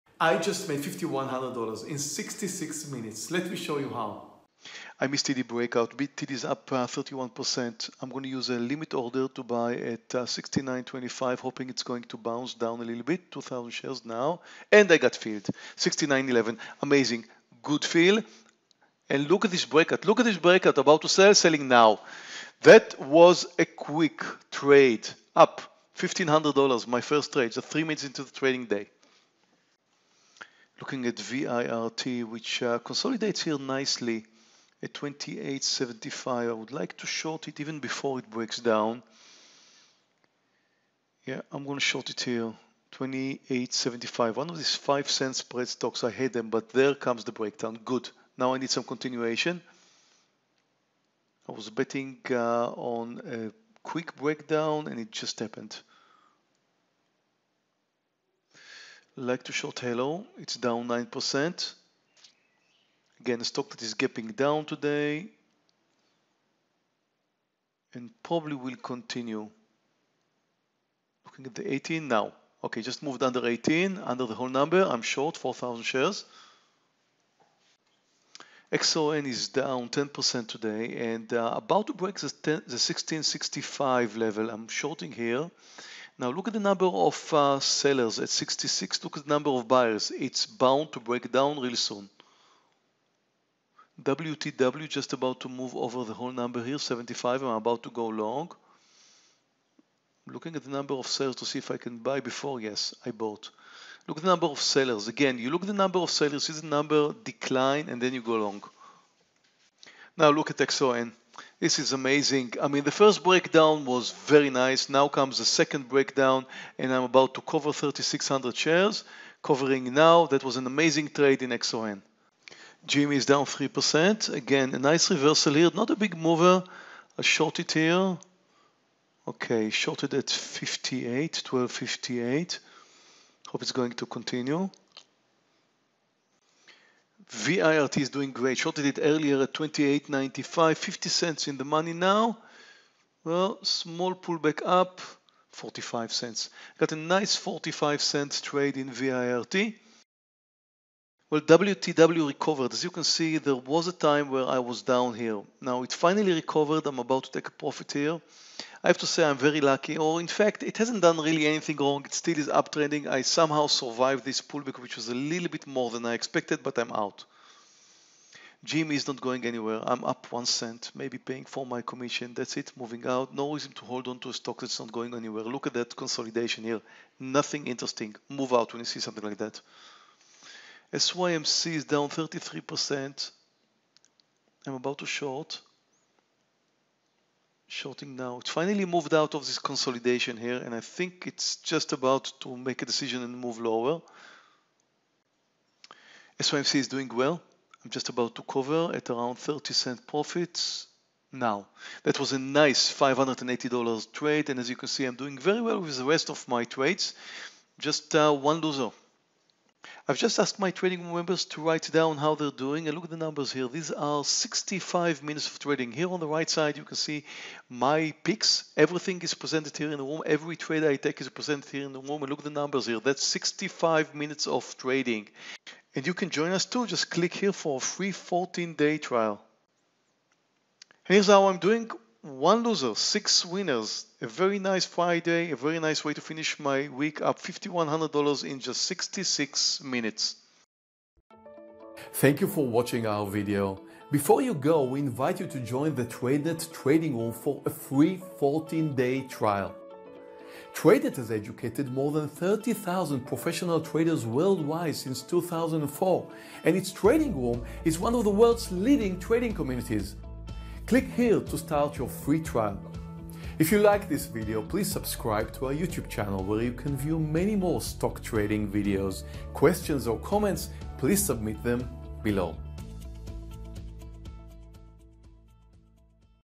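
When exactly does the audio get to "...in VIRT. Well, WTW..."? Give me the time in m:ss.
2:28.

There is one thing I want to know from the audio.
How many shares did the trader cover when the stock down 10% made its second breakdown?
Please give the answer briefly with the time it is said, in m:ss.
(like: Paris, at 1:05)
3,600, at 1:57.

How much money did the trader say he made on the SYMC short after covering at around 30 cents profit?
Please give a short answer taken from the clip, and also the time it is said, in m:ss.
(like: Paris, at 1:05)
$580, at 3:22.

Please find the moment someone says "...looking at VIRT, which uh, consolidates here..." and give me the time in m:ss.
0:30.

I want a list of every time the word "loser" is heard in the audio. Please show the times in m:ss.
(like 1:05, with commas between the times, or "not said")
3:28, 3:52.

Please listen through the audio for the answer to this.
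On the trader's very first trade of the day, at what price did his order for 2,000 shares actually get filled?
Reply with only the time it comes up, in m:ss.
0:15.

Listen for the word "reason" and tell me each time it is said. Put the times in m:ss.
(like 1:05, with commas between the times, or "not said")
2:53.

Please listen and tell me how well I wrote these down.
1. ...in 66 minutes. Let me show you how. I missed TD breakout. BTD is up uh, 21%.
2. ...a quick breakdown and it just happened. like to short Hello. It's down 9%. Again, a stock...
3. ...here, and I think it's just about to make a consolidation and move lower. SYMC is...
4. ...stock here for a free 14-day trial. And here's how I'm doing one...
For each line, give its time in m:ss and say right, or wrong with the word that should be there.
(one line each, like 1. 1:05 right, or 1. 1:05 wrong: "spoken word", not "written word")
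1. 0:01 wrong: "31", not "21"
2. 0:53 right
3. 3:10 wrong: "decision", not "consolidation"
4. 3:47 wrong: "click", not "stock".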